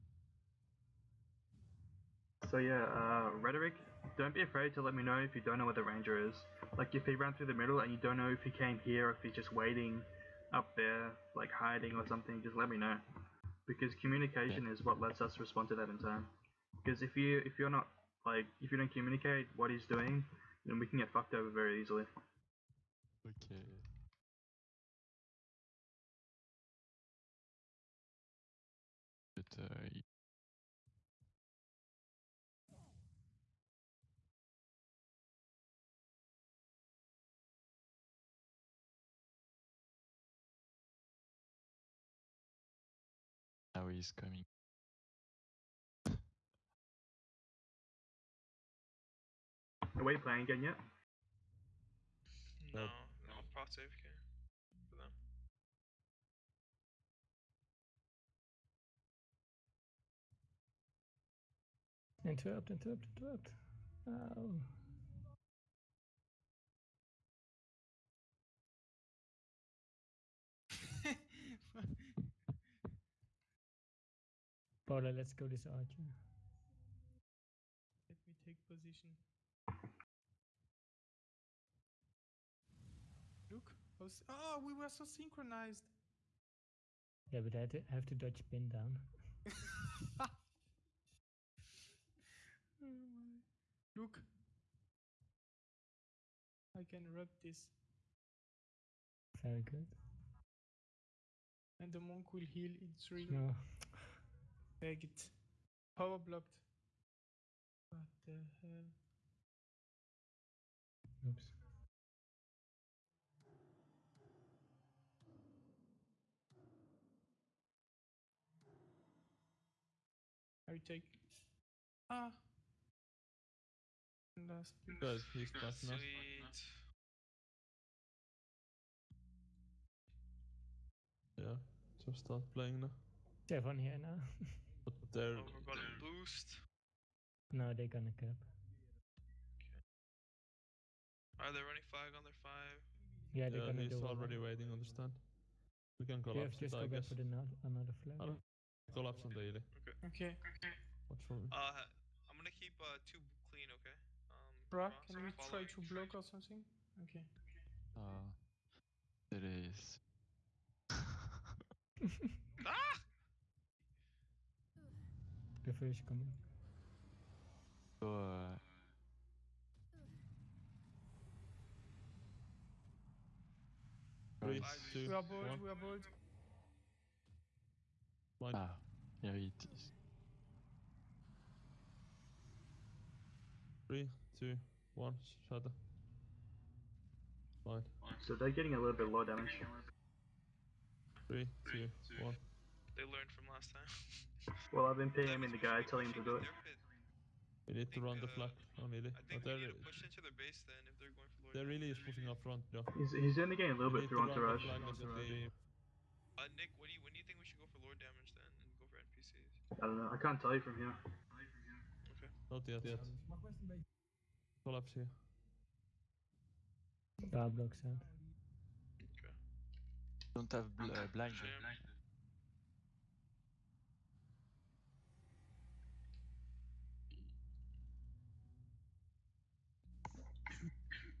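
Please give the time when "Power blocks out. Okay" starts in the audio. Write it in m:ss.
3:37.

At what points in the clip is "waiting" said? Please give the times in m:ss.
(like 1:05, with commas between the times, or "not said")
0:09, 2:24.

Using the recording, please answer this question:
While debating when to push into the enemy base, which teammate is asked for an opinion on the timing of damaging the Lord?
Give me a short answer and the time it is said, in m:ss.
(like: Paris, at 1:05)
Nick, at 3:26.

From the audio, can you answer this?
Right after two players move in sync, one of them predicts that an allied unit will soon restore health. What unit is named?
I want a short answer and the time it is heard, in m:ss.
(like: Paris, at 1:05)
monk, at 1:41.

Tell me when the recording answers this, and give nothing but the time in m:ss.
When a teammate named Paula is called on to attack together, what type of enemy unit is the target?
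1:15.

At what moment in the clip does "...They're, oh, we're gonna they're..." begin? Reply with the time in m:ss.
2:15.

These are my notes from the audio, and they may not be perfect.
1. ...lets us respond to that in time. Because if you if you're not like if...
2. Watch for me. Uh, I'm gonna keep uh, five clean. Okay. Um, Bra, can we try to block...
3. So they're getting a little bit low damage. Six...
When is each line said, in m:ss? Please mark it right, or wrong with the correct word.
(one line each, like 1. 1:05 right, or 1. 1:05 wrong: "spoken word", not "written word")
1. 0:14 right
2. 2:31 wrong: "two", not "five"
3. 3:08 wrong: "Three", not "Six".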